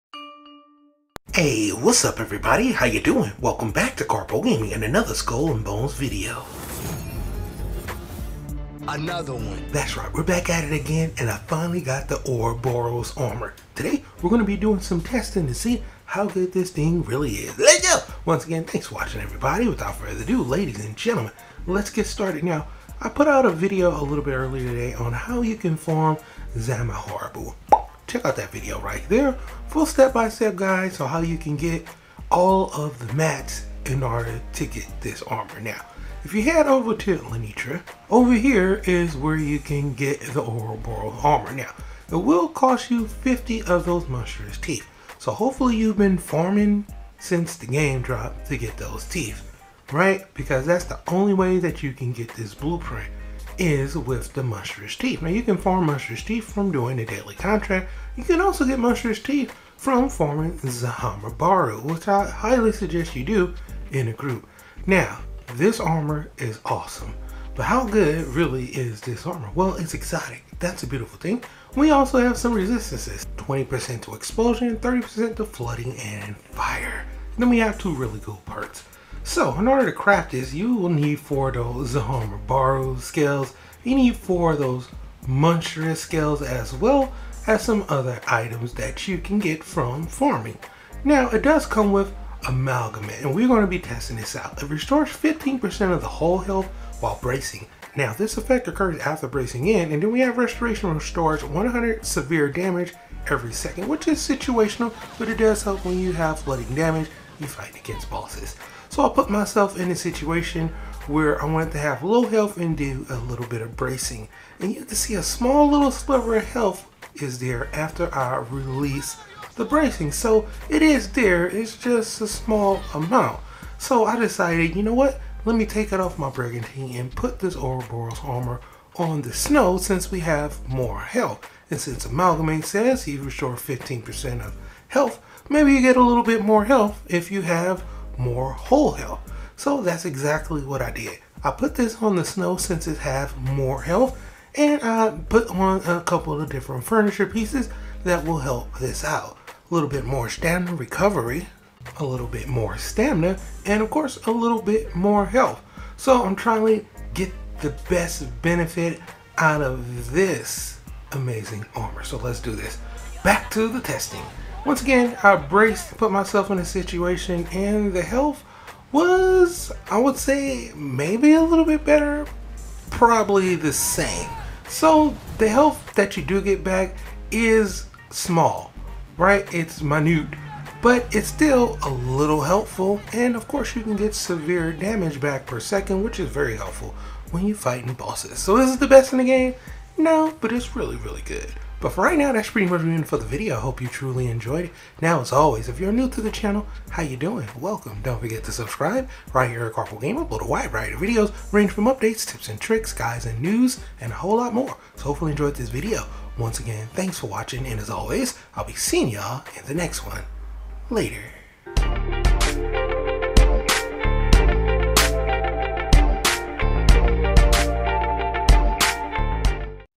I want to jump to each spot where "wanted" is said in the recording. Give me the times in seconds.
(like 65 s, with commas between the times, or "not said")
111 s.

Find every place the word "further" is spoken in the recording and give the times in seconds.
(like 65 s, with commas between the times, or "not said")
19 s.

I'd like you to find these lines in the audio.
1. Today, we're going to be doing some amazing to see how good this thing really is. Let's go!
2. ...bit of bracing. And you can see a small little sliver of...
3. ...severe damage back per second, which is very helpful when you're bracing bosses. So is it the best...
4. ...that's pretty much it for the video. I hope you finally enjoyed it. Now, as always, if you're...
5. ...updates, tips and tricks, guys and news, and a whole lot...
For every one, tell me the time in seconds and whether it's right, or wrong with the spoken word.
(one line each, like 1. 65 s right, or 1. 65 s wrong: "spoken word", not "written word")
1. 13 s wrong: "testing", not "amazing"
2. 113 s right
3. 184 s wrong: "fighting", not "bracing"
4. 192 s wrong: "truly", not "finally"
5. 201 s right.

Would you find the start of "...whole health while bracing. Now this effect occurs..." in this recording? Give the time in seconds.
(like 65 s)
96 s.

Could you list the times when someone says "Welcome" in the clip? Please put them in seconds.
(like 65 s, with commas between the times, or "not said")
3 s, 197 s.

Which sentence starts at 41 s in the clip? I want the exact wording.
Now, it will cost you 50 of those monstrous teeth.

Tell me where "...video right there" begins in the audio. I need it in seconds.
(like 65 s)
28 s.